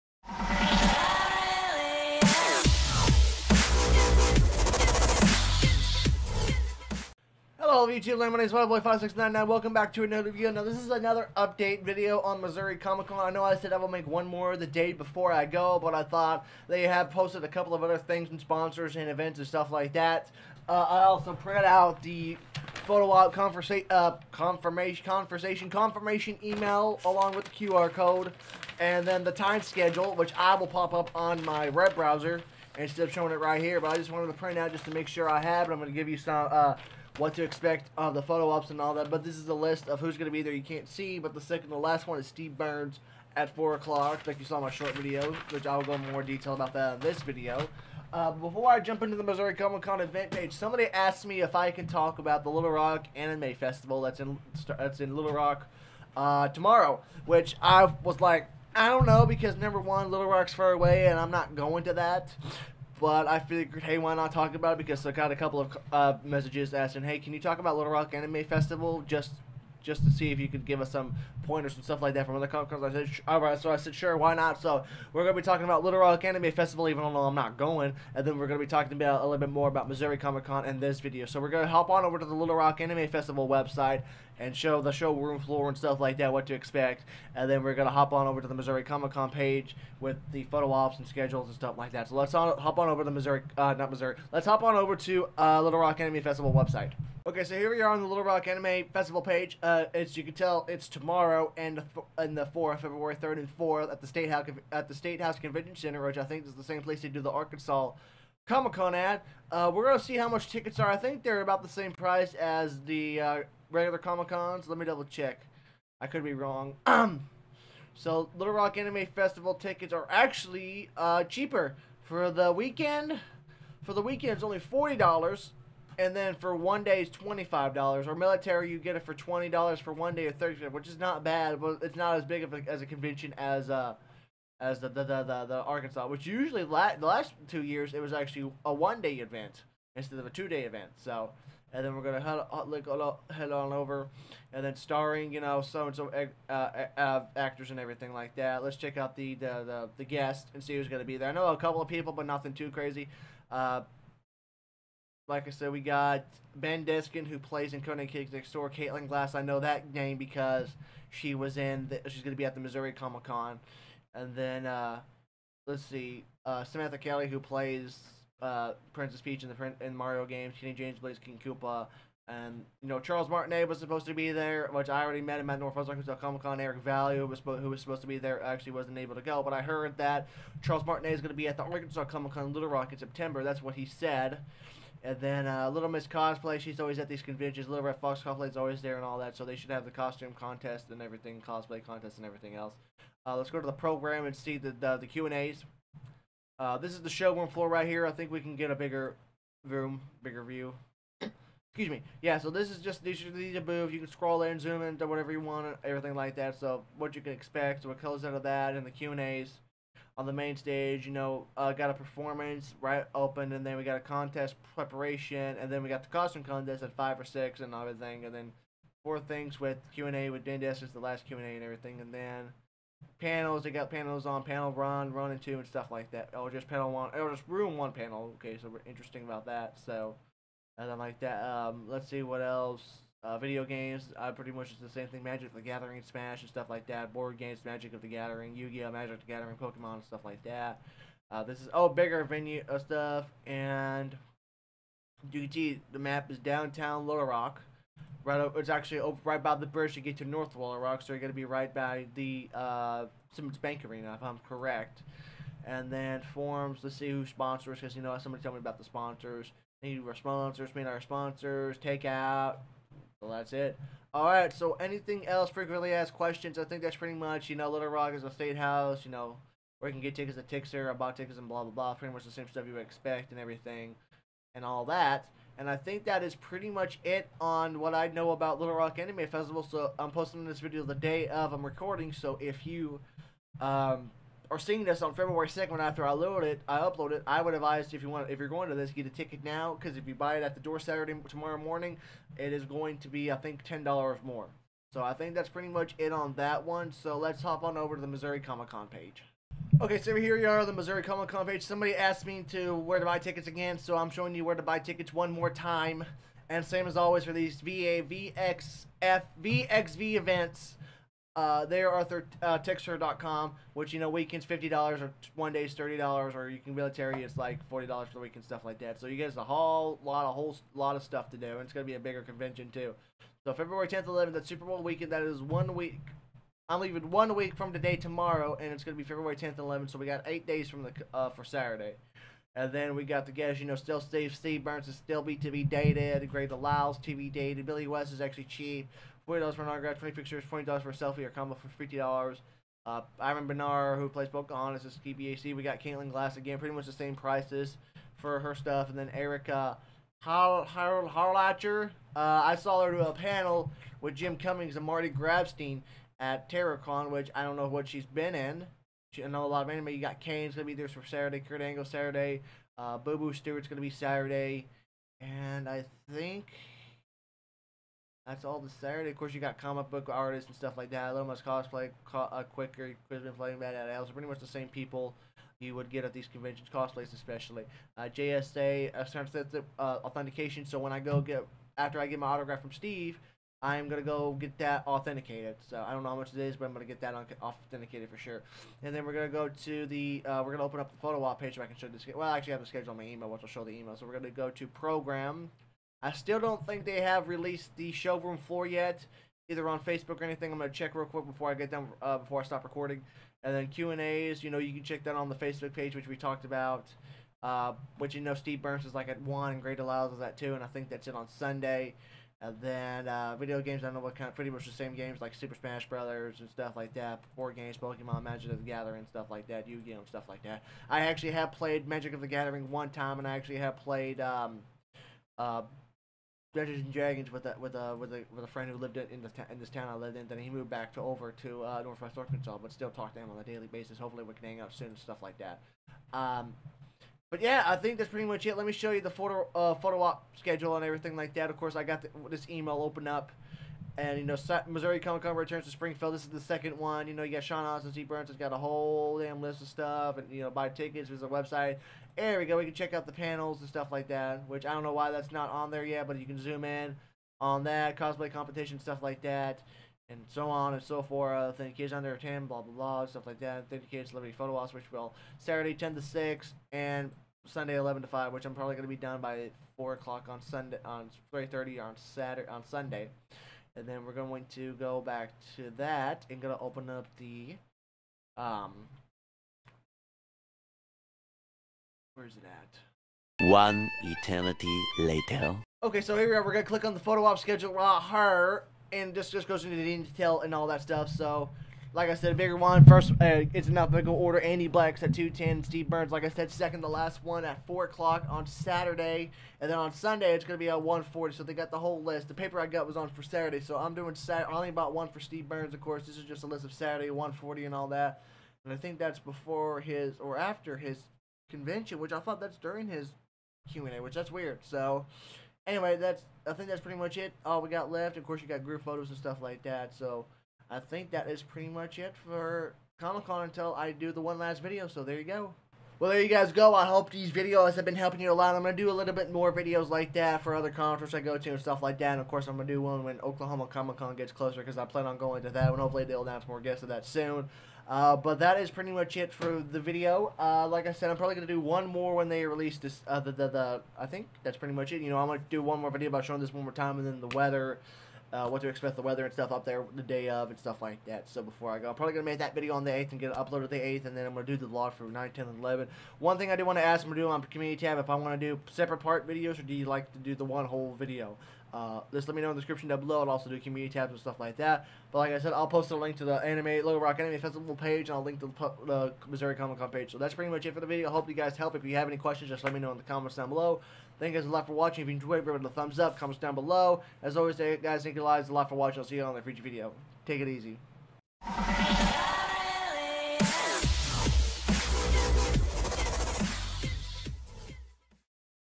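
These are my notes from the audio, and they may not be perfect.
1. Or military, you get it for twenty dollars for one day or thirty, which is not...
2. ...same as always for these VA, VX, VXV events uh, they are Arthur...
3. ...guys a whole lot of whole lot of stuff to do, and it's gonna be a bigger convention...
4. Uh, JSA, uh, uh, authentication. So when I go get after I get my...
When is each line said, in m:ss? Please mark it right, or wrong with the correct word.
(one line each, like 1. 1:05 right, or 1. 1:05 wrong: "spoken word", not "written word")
1. 2:08 right
2. 5:06 right
3. 5:19 right
4. 6:17 right.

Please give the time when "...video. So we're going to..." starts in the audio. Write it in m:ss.
1:20.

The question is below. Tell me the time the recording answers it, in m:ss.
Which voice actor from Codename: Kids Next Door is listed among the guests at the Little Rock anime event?
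2:36.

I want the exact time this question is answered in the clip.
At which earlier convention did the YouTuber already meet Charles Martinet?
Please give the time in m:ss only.
2:55.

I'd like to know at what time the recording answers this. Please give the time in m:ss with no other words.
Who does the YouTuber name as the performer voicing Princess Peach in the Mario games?
2:46.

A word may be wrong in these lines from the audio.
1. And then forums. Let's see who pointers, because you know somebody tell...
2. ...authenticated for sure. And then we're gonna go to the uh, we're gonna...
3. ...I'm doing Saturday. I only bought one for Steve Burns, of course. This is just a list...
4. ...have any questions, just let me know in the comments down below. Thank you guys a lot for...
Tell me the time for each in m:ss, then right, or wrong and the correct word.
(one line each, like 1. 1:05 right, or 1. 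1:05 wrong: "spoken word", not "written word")
1. 4:15 wrong: "sponsors", not "pointers"
2. 6:27 right
3. 8:23 right
4. 9:31 right.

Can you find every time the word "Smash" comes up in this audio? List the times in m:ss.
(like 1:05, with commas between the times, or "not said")
3:56, 6:55.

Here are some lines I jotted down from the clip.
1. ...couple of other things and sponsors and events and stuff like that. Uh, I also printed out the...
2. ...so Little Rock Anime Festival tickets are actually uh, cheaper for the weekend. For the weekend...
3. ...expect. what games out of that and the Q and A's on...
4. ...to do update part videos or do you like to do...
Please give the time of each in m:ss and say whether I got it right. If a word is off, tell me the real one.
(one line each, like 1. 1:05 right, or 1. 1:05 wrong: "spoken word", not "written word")
1. 0:17 right
2. 1:57 right
3. 3:27 wrong: "comes", not "games"
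4. 9:18 wrong: "separate", not "update".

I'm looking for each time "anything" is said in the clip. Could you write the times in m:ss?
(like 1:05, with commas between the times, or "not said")
4:24, 6:40.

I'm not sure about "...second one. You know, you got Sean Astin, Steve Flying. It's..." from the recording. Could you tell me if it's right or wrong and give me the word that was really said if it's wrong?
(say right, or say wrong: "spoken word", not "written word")
wrong: "Burns", not "Flying".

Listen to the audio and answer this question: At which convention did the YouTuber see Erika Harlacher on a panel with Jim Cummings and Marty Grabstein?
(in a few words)
TerraCon.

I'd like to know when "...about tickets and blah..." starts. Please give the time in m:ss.
4:30.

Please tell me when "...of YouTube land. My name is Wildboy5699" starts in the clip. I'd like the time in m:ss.
0:07.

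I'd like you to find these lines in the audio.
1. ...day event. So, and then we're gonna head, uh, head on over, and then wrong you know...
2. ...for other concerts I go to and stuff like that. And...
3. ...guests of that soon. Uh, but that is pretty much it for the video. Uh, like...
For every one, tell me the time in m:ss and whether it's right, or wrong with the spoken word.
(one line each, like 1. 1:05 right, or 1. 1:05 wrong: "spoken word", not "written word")
1. 2:20 wrong: "starring", not "wrong"
2. 8:50 right
3. 8:56 right.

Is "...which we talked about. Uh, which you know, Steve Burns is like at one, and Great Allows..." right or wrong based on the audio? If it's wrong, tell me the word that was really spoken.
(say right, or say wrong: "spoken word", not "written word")
right.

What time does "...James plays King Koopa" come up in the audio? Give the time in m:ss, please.
2:50.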